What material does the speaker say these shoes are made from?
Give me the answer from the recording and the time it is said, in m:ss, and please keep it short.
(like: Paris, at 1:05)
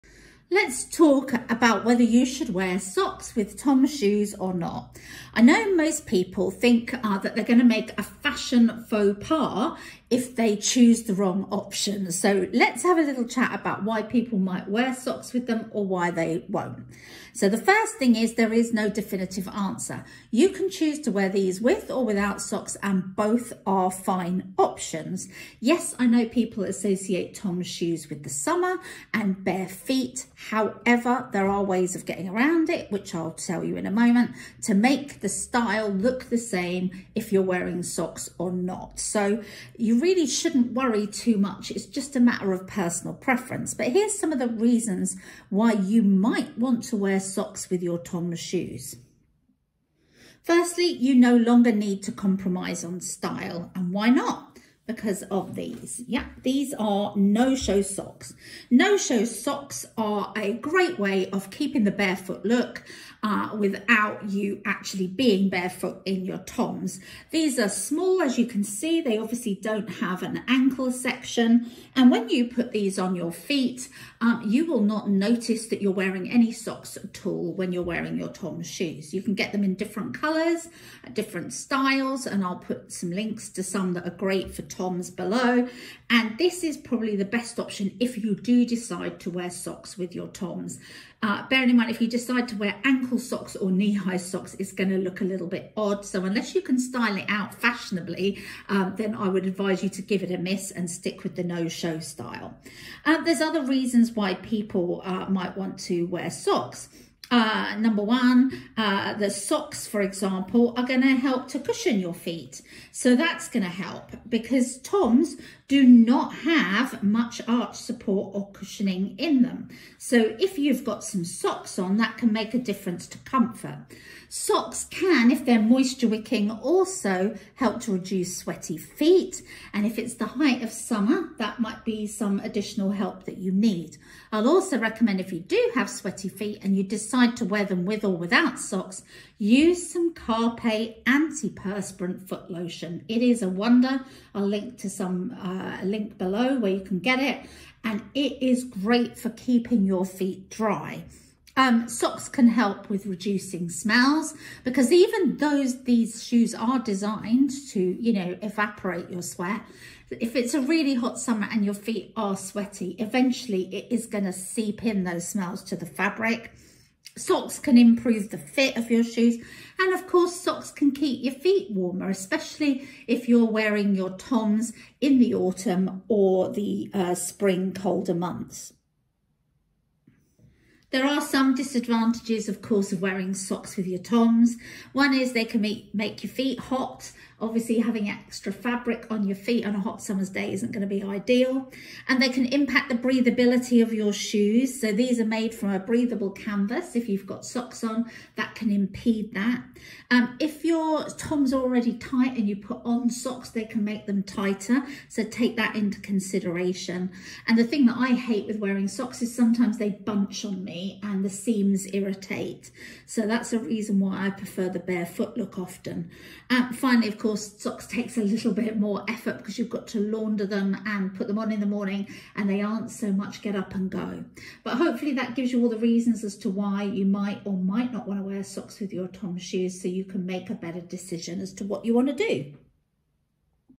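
Breathable canvas, at 3:15.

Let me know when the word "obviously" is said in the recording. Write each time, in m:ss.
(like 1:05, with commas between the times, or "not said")
1:09, 3:07.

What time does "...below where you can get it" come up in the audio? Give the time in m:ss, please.
2:26.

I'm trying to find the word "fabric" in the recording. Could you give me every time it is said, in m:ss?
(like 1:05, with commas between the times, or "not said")
2:45, 3:08.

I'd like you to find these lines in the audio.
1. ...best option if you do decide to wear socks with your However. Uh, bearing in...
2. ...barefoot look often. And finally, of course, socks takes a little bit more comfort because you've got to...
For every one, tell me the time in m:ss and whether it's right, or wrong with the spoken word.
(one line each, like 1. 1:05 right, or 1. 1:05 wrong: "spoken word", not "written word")
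1. 1:27 wrong: "Toms", not "However"
2. 3:34 wrong: "effort", not "comfort".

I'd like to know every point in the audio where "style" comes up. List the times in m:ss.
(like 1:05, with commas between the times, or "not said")
0:35, 0:52, 1:21, 1:36, 1:41.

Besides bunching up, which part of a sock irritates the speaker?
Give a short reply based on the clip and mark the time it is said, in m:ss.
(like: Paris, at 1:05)
The seams, at 3:31.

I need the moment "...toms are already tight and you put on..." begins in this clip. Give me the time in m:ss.
3:21.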